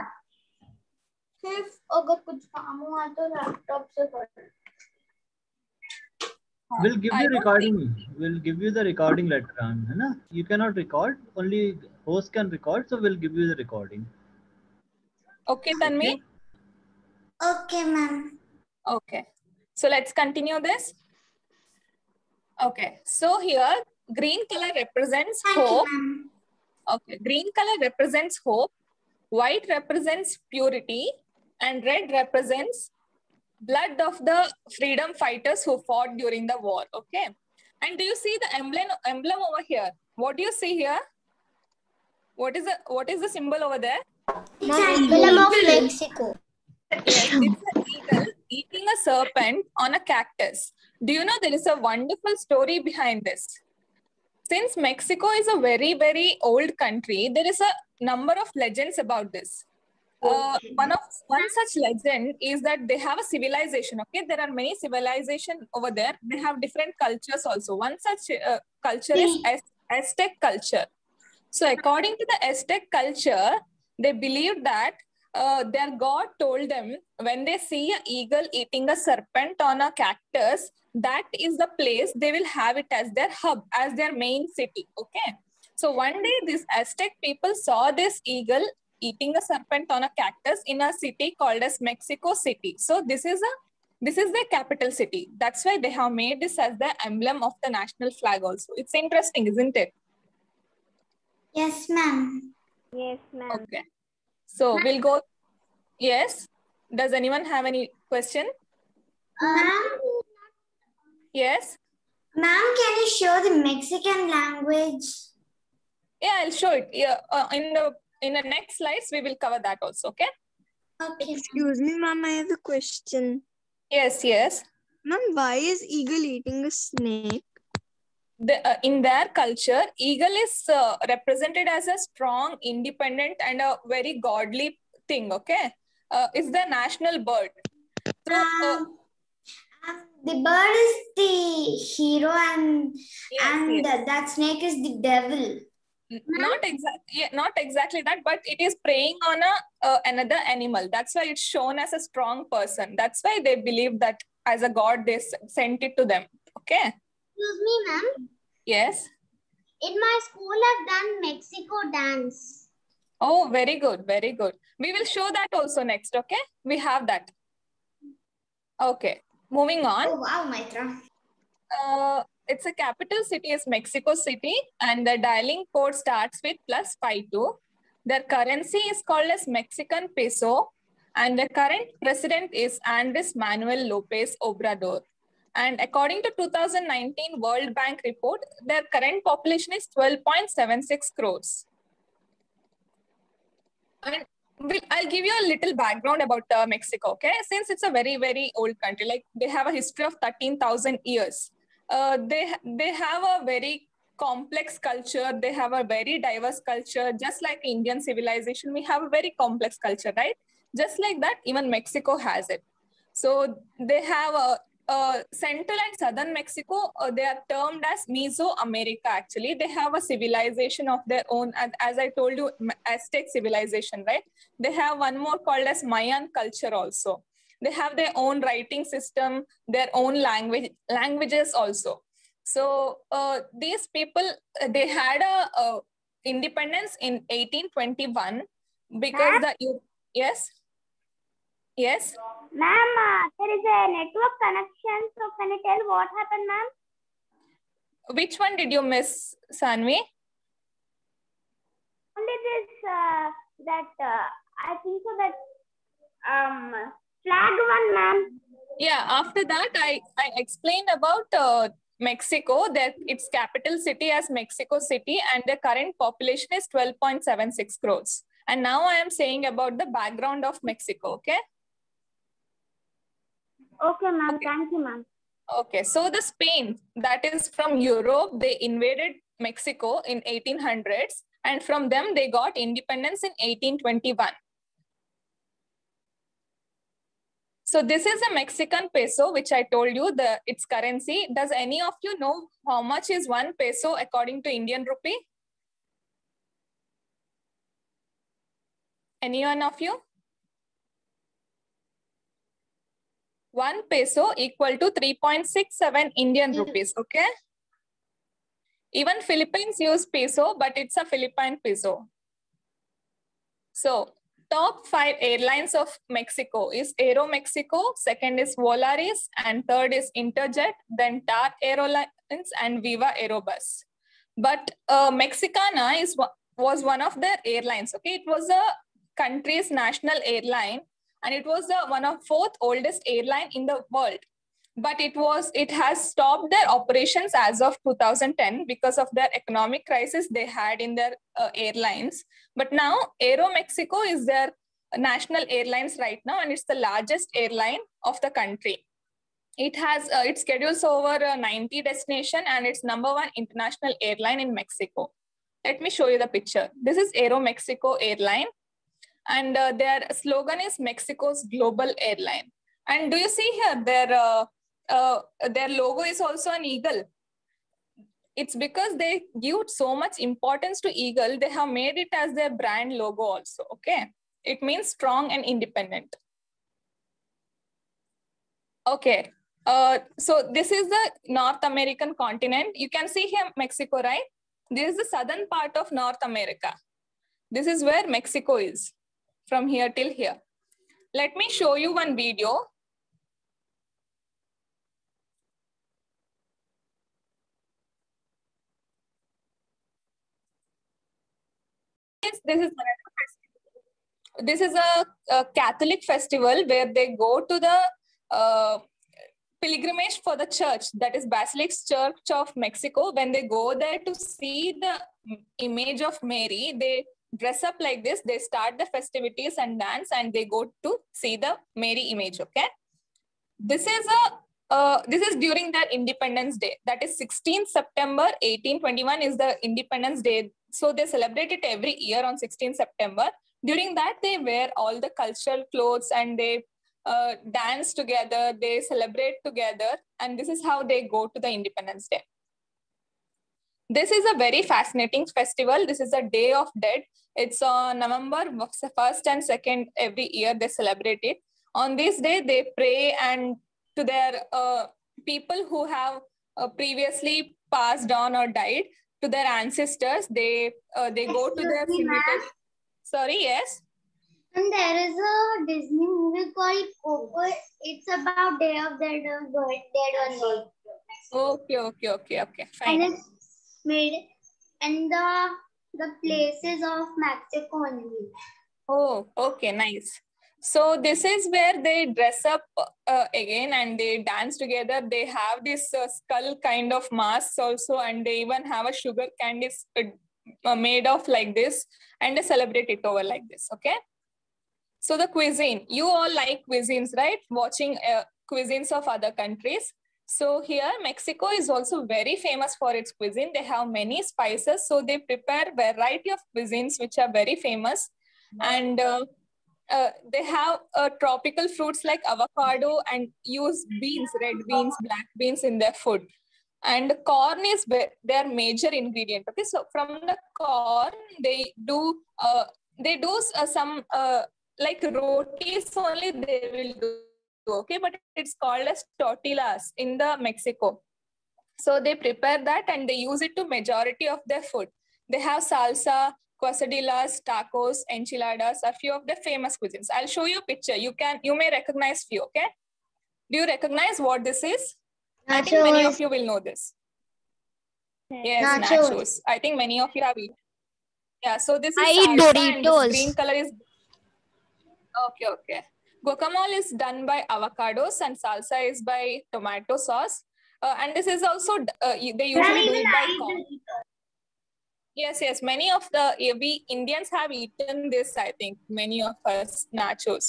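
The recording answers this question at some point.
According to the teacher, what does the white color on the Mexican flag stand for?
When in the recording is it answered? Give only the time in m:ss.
0:30.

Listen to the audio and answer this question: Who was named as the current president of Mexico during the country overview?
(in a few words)
Andres Manuel Lopez Obrador.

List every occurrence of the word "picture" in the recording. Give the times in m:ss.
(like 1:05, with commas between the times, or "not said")
5:56, 9:00.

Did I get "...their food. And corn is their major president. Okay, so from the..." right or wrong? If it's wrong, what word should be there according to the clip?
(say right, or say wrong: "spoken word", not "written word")
wrong: "ingredient", not "president".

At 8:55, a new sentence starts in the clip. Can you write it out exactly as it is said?
They have salsa, quesadillas, tacos, enchiladas are few of the famous cuisines.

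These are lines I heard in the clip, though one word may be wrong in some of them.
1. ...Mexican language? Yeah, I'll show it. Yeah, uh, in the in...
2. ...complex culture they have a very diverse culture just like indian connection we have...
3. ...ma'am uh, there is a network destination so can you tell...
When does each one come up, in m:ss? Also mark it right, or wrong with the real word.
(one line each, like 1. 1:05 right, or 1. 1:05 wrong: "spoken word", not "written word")
1. 1:53 right
2. 3:24 wrong: "civilization", not "connection"
3. 4:02 wrong: "connection", not "destination".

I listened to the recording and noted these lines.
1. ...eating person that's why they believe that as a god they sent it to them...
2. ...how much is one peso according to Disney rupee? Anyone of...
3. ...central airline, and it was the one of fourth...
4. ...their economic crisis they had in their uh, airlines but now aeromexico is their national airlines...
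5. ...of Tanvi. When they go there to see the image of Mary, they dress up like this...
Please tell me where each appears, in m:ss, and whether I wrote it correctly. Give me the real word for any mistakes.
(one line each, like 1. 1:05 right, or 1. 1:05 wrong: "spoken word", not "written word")
1. 2:32 wrong: "strong", not "eating"
2. 4:52 wrong: "Indian", not "Disney"
3. 5:29 wrong: "national", not "central"
4. 5:39 right
5. 6:52 wrong: "Mexico", not "Tanvi".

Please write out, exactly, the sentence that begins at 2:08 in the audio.
The, uh, in their culture, eagle is uh, represented as a strong, independent, and a very godly thing, okay?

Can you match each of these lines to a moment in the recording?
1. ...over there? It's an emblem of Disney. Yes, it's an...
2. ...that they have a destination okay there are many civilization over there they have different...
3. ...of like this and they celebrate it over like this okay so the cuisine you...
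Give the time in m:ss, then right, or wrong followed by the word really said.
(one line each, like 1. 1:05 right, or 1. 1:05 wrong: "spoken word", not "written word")
1. 0:43 wrong: "Mexico", not "Disney"
2. 1:02 wrong: "civilization", not "destination"
3. 8:11 right.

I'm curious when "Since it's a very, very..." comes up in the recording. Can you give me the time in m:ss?
3:17.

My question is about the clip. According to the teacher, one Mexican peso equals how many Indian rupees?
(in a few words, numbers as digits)
3.67.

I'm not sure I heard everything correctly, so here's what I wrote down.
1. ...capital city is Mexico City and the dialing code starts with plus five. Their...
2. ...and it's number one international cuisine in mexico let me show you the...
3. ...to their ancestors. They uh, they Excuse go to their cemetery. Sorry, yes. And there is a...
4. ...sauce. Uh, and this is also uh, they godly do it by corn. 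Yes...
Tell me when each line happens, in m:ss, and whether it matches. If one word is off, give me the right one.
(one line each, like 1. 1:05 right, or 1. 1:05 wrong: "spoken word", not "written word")
1. 2:52 wrong: "two", not "five"
2. 5:52 wrong: "airline", not "cuisine"
3. 7:39 right
4. 9:19 wrong: "usually", not "godly".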